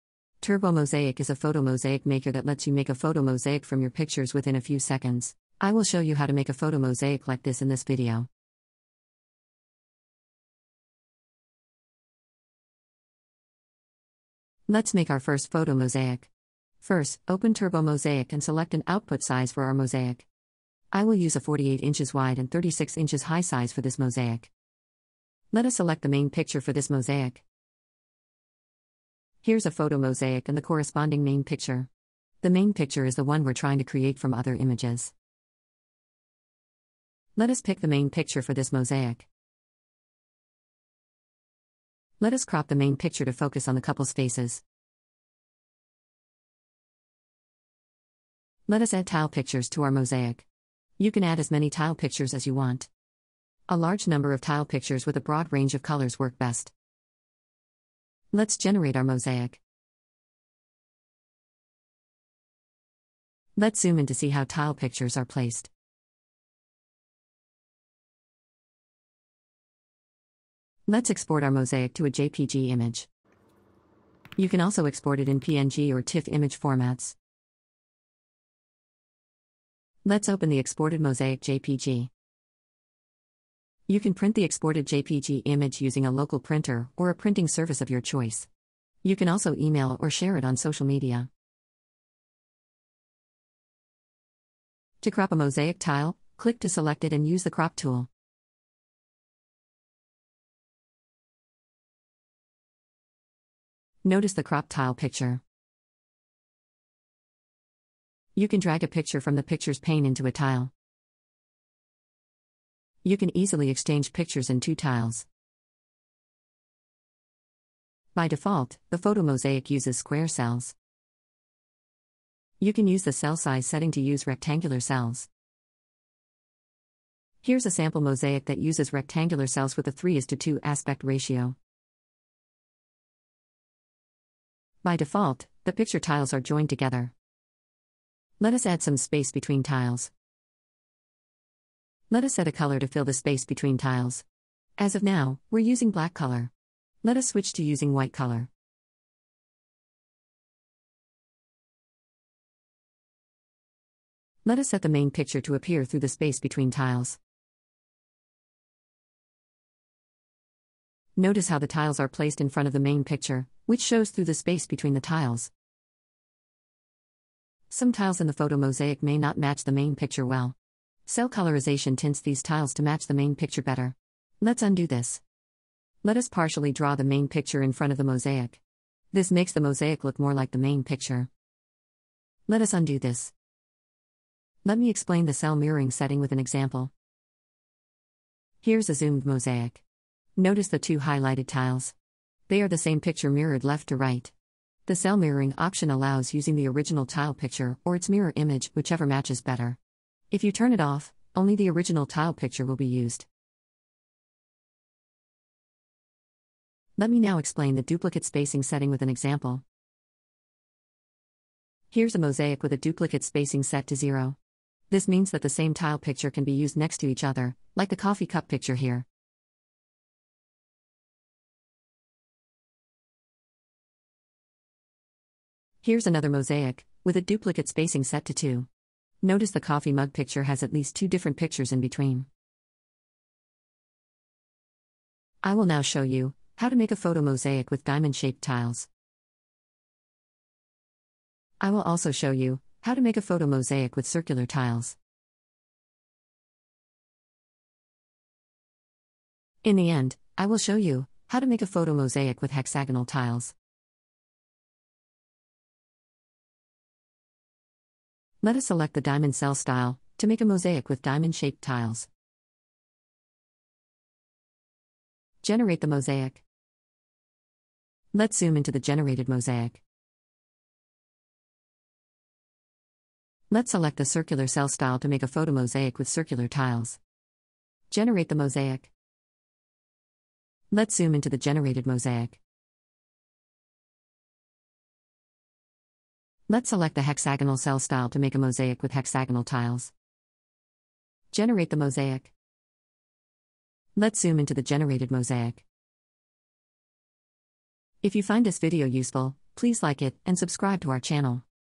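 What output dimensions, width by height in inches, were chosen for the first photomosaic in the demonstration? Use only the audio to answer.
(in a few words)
48 x 36 inches.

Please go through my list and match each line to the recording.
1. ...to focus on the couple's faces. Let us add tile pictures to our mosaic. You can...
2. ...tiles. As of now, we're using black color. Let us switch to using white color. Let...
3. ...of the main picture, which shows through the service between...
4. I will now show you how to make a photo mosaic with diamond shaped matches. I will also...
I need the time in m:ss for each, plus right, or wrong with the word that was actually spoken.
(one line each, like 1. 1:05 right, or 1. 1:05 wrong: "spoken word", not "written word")
1. 0:43 right
2. 2:23 right
3. 2:42 wrong: "space", not "service"
4. 3:55 wrong: "tiles", not "matches".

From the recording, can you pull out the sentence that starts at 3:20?
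If you turn it off, only the original tile picture will be used.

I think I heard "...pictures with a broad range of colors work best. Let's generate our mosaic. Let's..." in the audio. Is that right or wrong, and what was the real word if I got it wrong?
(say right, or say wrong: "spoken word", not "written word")
right.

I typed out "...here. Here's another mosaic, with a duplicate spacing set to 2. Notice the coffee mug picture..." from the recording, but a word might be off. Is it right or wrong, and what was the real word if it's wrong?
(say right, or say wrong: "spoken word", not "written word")
right.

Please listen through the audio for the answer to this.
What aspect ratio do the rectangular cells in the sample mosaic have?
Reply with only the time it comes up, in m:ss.
2:09.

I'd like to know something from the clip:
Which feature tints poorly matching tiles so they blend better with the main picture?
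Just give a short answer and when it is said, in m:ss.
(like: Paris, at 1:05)
Cell colorization, at 2:51.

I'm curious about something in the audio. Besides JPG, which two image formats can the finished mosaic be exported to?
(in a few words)
PNG or TIFF.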